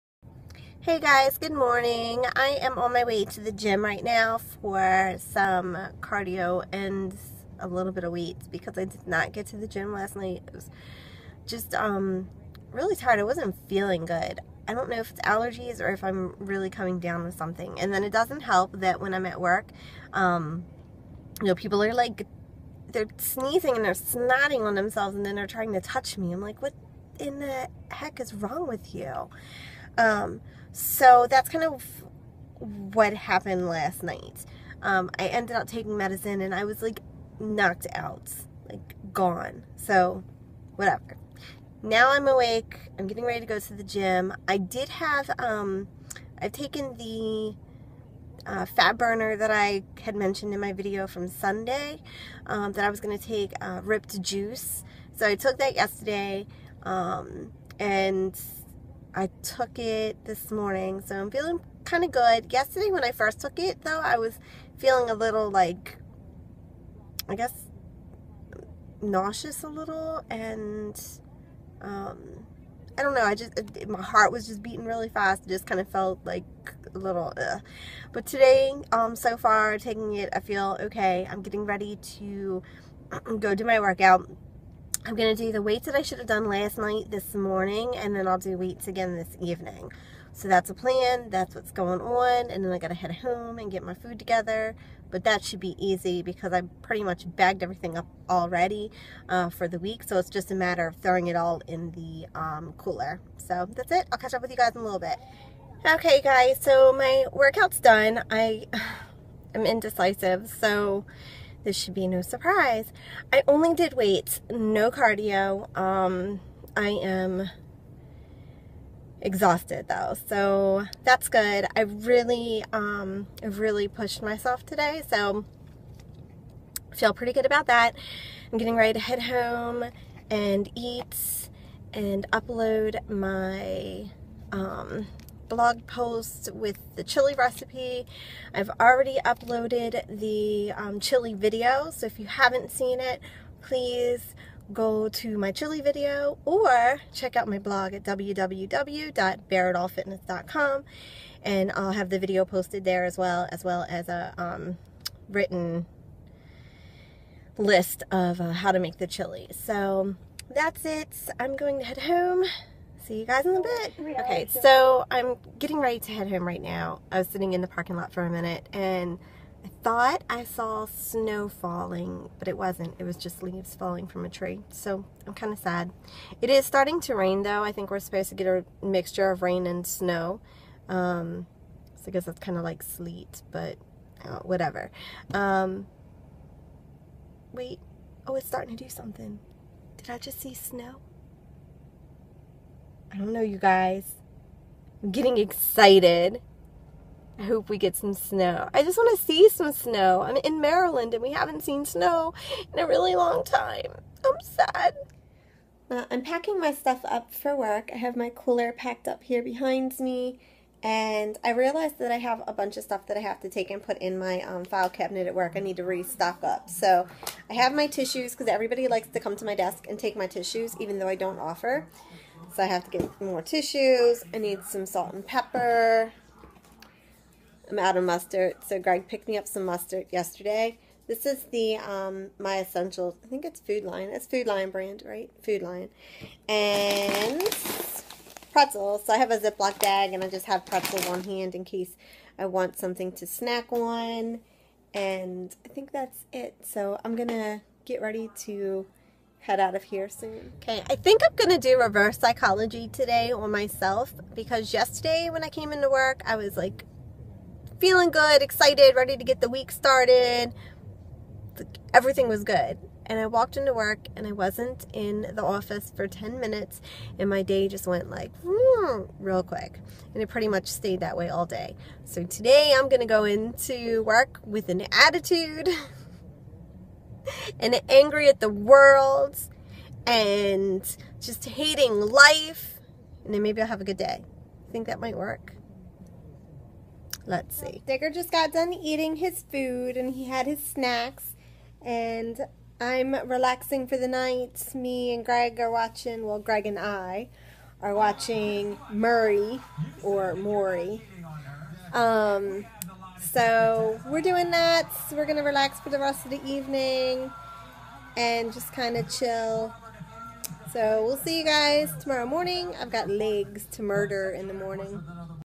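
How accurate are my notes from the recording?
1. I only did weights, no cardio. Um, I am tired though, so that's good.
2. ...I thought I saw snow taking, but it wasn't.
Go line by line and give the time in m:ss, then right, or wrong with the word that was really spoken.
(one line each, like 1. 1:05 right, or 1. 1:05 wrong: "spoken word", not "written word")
1. 1:53 wrong: "exhausted", not "tired"
2. 2:49 wrong: "falling", not "taking".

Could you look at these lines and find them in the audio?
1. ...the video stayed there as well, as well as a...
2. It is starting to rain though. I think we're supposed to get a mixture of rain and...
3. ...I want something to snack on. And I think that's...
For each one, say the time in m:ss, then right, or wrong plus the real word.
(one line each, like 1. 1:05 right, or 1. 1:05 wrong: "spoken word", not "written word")
1. 2:32 wrong: "posted", not "stayed"
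2. 2:56 right
3. 4:02 right.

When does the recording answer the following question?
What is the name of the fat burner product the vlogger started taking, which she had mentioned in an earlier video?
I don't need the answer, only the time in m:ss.
0:53.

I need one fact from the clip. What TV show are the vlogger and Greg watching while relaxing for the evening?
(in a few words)
Maury.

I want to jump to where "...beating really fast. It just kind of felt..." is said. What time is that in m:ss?
1:14.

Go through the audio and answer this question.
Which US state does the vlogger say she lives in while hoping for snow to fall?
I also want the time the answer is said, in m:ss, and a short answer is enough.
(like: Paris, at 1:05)
Maryland, at 3:20.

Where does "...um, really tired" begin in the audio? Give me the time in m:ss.
0:11.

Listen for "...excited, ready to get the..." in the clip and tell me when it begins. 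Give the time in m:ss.
4:18.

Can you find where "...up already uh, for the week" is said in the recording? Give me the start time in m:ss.
1:37.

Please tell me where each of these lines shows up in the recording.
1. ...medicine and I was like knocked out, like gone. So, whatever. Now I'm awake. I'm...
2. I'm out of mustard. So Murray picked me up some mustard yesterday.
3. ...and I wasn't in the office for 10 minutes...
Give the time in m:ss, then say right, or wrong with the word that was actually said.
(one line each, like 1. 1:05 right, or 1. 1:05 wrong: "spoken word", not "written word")
1. 0:35 right
2. 3:47 wrong: "Greg", not "Murray"
3. 4:24 right.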